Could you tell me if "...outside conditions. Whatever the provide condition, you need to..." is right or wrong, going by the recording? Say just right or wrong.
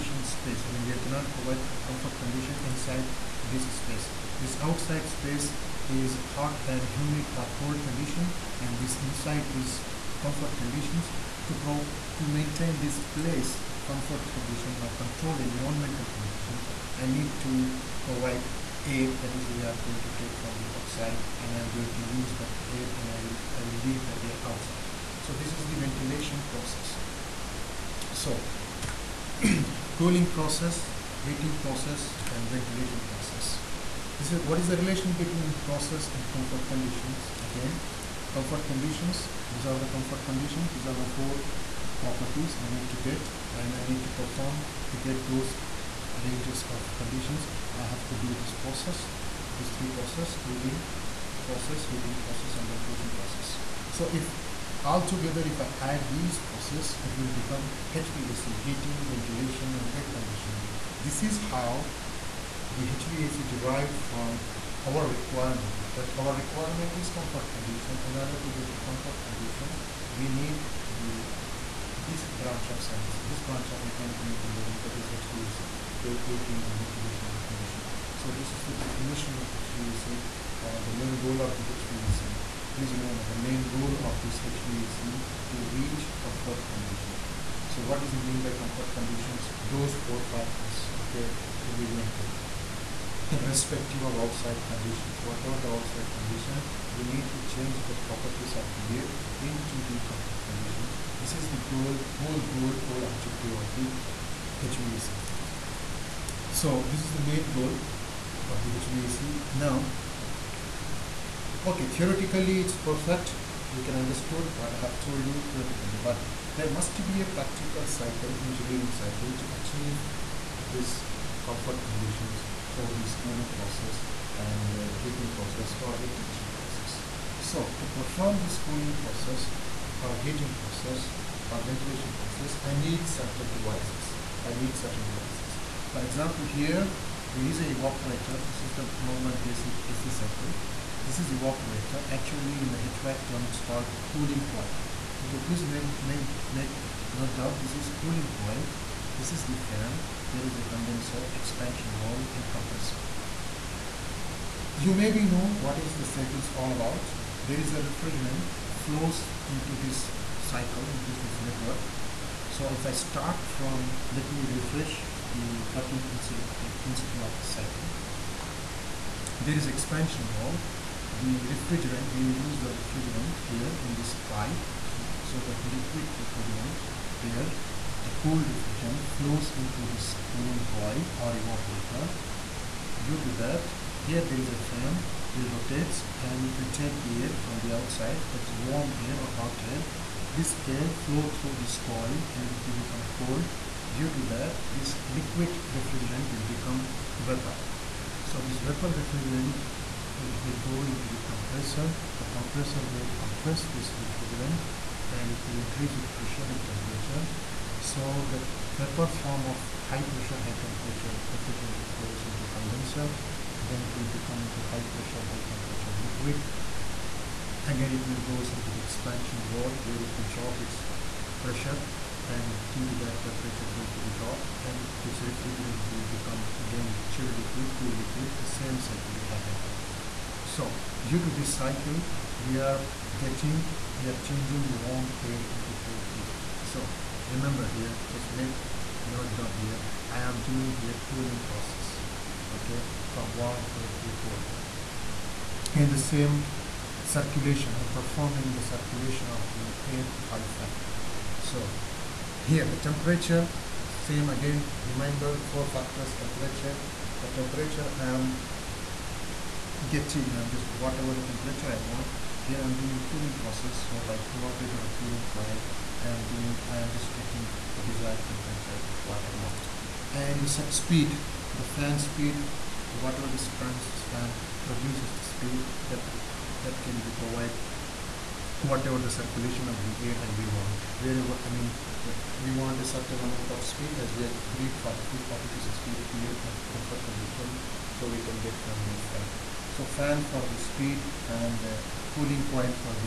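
wrong.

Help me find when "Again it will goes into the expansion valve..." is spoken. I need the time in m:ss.
3:37.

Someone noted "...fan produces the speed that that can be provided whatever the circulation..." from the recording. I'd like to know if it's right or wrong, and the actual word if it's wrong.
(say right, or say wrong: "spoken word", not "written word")
right.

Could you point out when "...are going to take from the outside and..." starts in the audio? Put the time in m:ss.
0:19.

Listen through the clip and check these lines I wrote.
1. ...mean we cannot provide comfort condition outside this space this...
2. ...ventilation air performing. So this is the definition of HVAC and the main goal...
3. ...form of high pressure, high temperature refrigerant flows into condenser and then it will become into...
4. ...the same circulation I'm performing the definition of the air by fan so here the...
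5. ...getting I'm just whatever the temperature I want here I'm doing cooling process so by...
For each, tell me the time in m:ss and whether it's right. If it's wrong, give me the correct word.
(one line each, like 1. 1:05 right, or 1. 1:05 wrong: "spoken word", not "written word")
1. 0:00 wrong: "inside", not "outside"
2. 1:16 wrong: "conditioning", not "performing"
3. 3:29 right
4. 4:05 wrong: "circulation", not "definition"
5. 4:19 right.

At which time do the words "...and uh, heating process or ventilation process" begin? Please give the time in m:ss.
2:04.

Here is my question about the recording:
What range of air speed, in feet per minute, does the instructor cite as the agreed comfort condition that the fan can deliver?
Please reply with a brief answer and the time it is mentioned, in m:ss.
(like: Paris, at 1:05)
40 to 60 fpm, at 4:45.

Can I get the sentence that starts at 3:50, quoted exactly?
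So due to this cycle we are getting, we are changing the warm air into cold air.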